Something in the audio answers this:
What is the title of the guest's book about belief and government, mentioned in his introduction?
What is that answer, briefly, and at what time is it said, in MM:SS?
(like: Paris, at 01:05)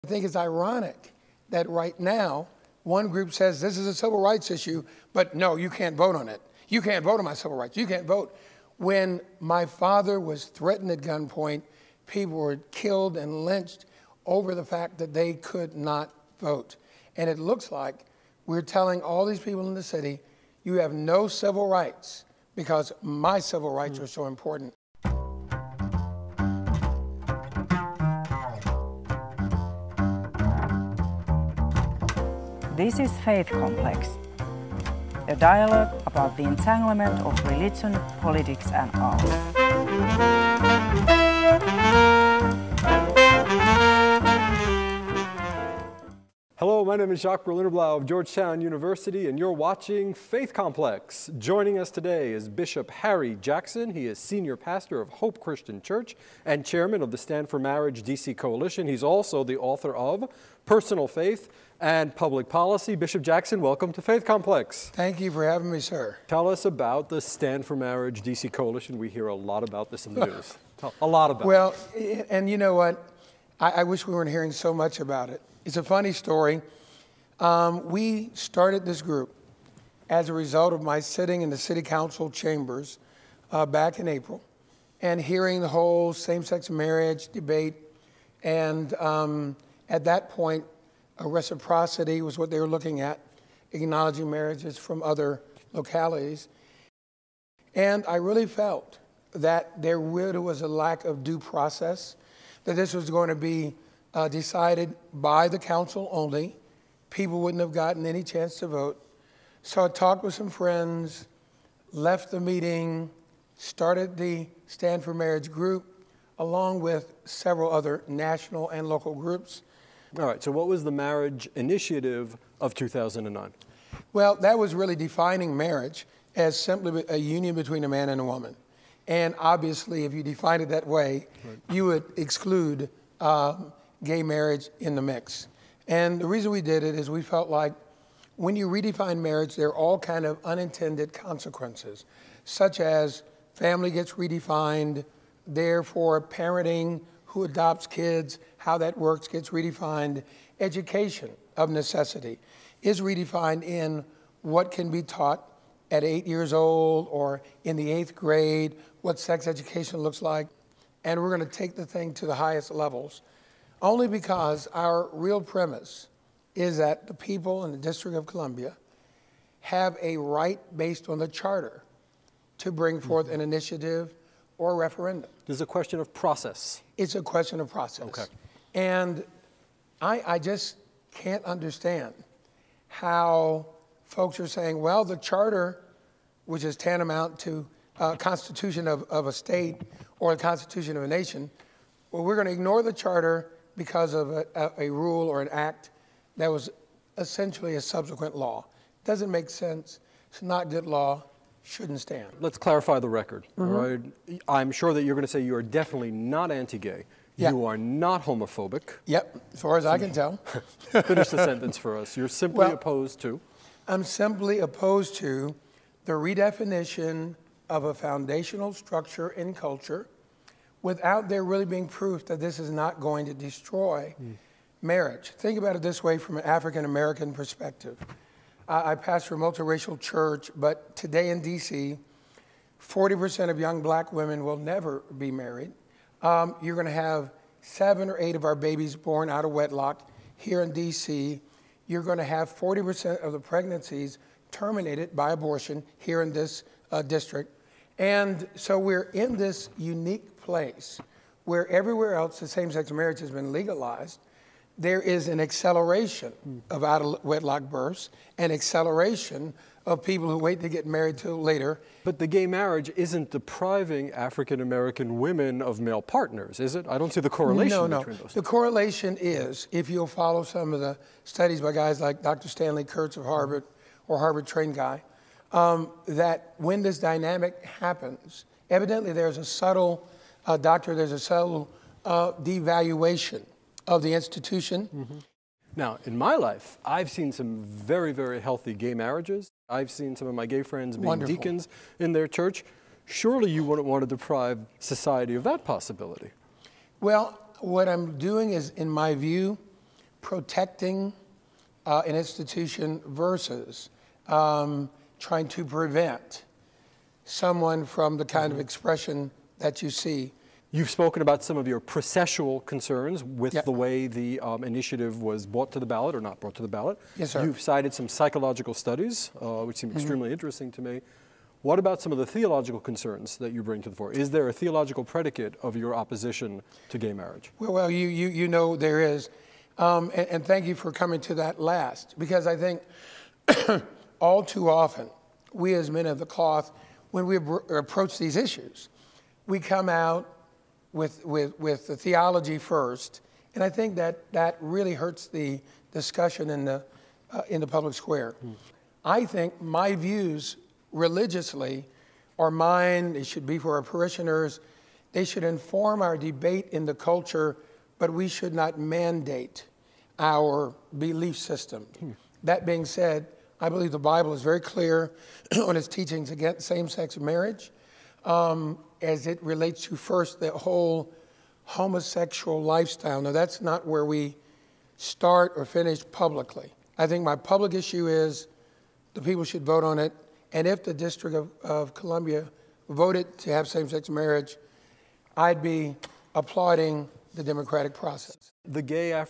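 Personal Faith and Public Policy, at 01:00.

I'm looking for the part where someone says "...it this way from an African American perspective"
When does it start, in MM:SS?
03:45.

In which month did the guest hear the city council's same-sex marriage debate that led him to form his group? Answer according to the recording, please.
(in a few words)
April.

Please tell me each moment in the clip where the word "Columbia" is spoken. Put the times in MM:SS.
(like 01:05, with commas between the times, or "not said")
02:48, 06:21.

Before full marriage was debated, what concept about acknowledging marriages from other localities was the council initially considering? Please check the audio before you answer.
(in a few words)
Reciprocity.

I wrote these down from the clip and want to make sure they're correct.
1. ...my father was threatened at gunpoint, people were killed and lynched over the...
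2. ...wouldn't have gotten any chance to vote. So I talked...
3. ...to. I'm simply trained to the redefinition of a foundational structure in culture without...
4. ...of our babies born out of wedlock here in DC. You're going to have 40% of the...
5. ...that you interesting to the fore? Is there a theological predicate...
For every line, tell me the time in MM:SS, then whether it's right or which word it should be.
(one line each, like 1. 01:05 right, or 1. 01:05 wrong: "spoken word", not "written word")
1. 00:09 right
2. 01:47 right
3. 03:33 wrong: "opposed", not "trained"
4. 03:58 right
5. 05:23 wrong: "bring", not "interesting".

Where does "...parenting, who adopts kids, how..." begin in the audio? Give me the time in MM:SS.
02:26.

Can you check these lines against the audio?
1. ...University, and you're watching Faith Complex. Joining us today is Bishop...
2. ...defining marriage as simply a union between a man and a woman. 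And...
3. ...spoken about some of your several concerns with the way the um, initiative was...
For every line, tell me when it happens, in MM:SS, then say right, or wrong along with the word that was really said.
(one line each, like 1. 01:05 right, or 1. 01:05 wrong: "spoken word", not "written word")
1. 00:48 right
2. 02:04 right
3. 05:10 wrong: "processual", not "several".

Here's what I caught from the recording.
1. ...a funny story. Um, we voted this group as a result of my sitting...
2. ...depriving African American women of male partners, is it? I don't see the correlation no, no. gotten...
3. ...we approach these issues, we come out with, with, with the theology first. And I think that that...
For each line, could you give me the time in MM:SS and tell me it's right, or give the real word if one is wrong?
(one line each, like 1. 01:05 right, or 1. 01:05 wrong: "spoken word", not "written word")
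1. 01:15 wrong: "started", not "voted"
2. 04:23 wrong: "between", not "gotten"
3. 05:37 right.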